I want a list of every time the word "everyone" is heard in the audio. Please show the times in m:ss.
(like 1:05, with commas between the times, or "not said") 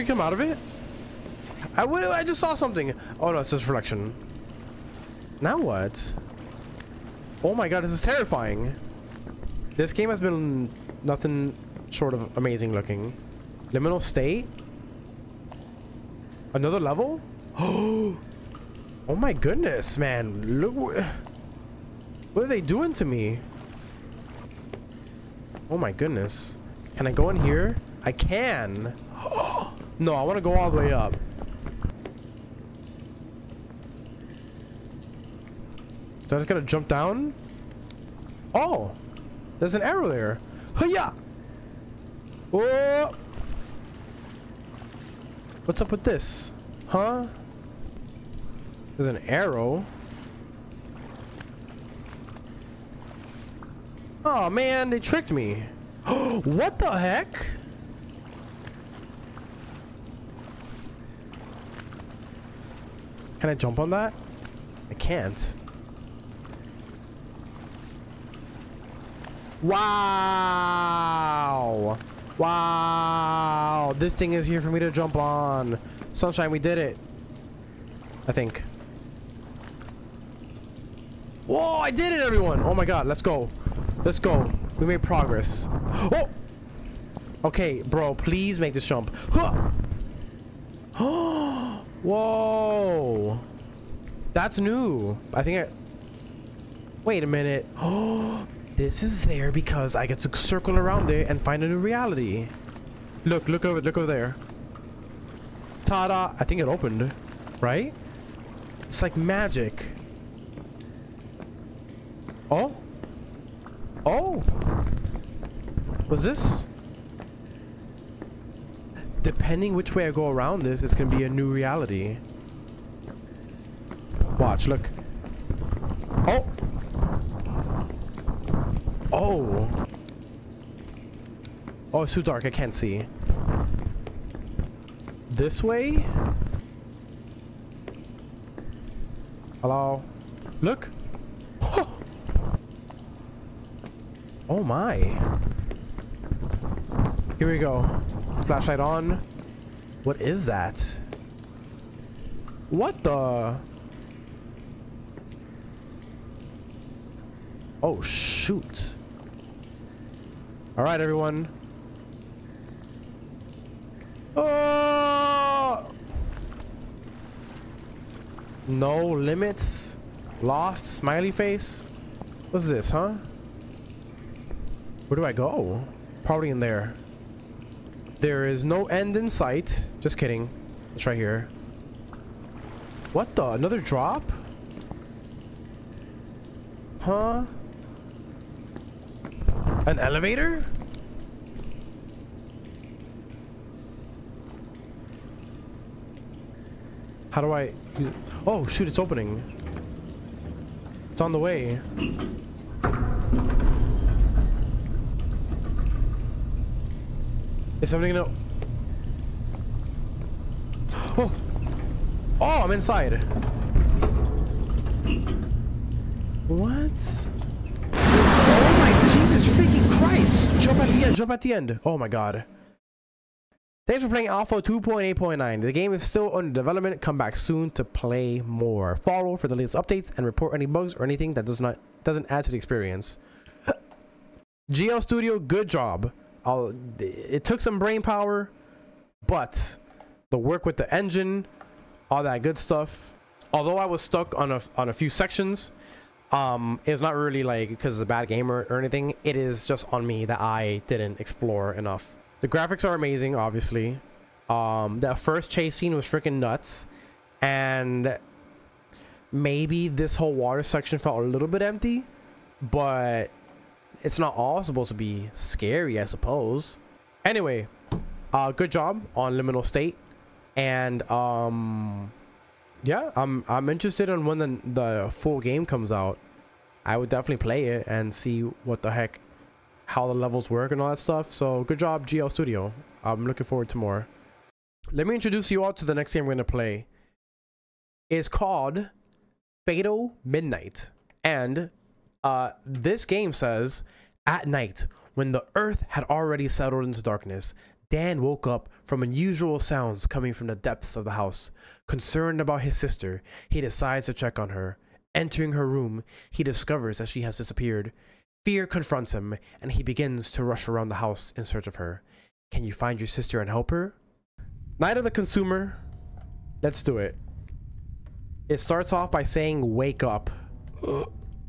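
1:22, 2:41.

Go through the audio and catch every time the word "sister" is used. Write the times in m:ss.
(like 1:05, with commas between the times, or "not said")
5:02, 5:13.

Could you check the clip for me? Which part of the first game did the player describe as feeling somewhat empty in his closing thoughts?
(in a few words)
water section.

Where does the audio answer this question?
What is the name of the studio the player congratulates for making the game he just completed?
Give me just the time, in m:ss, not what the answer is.
4:42.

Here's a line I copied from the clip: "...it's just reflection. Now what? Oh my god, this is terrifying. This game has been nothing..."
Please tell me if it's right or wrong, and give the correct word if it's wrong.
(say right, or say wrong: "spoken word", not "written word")
right.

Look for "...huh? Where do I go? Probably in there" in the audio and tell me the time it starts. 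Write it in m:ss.
2:52.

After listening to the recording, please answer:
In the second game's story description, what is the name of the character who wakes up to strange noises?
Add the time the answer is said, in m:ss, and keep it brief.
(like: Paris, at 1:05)
Dan, at 4:57.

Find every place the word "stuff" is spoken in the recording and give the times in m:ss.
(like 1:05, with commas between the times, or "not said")
4:02, 4:40.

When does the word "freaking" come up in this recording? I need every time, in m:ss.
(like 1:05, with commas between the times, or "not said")
3:39, 4:16.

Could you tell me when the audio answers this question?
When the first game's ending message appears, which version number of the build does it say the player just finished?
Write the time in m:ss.
3:44.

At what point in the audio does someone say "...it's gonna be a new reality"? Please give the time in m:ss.
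2:00.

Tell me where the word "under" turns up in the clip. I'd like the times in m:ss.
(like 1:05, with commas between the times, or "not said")
3:46.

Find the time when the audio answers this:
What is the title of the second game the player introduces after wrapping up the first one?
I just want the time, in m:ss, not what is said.
4:49.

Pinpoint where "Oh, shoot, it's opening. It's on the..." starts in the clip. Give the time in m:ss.
3:18.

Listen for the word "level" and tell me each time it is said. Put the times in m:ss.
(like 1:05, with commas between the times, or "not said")
0:16, 4:40.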